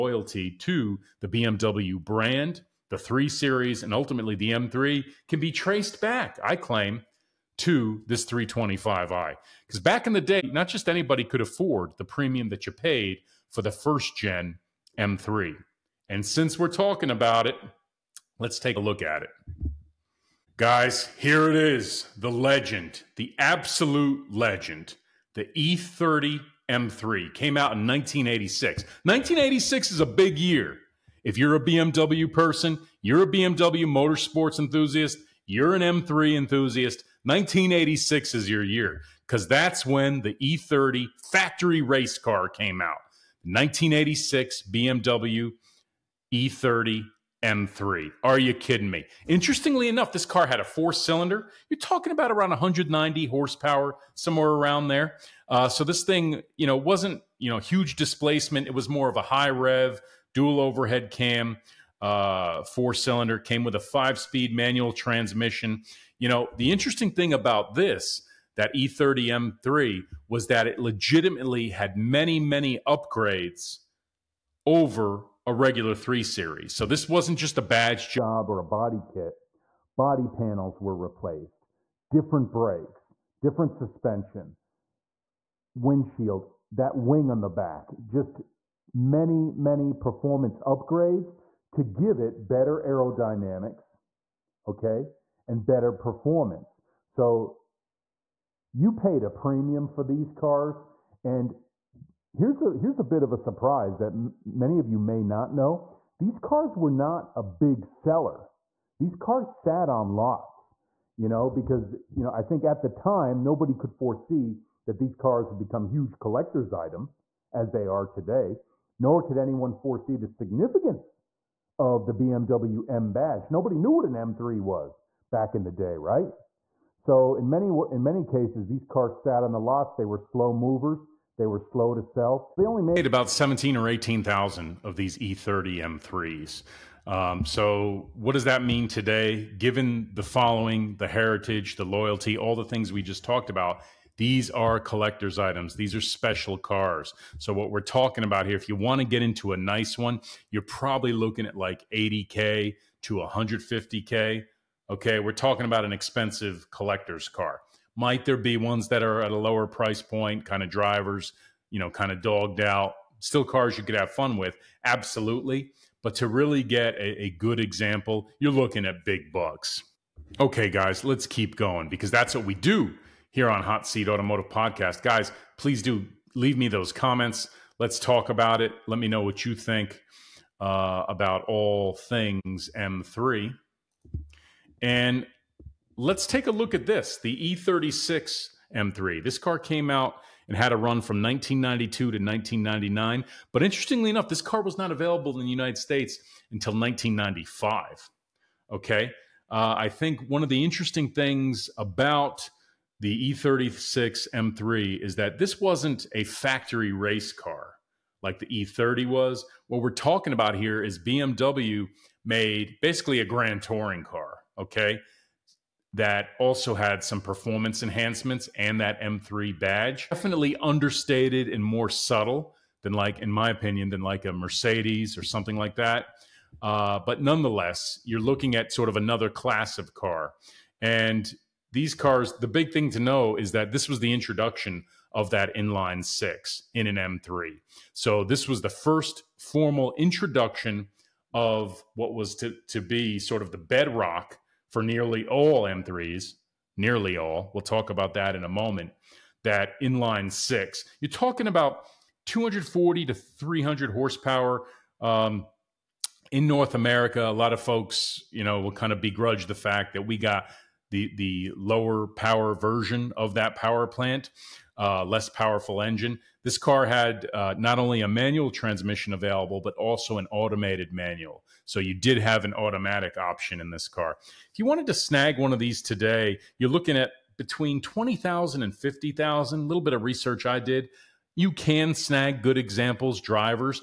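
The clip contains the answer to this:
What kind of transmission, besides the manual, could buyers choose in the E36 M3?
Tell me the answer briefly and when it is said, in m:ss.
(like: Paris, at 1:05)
Automated manual, at 4:30.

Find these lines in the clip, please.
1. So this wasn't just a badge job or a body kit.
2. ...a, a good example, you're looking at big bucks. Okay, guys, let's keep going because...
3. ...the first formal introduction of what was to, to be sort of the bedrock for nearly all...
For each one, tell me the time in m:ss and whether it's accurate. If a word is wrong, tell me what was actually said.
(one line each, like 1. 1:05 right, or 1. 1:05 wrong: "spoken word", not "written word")
1. 1:16 right
2. 2:46 right
3. 3:58 right.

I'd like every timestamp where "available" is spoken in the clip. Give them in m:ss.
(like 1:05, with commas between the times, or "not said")
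3:14, 4:29.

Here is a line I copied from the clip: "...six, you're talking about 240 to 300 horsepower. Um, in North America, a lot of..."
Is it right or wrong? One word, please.
right.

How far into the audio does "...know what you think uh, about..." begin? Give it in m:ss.
2:59.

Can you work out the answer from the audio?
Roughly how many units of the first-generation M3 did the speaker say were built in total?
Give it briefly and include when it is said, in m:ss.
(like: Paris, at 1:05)
17,000 to 18,000, at 2:13.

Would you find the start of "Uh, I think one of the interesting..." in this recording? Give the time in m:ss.
3:19.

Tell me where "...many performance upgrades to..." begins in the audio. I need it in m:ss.
1:29.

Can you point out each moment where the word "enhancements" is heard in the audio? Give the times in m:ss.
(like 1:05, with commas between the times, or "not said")
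3:37.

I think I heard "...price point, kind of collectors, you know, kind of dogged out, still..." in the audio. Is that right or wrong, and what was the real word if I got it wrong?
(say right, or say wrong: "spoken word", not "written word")
wrong: "drivers", not "collectors".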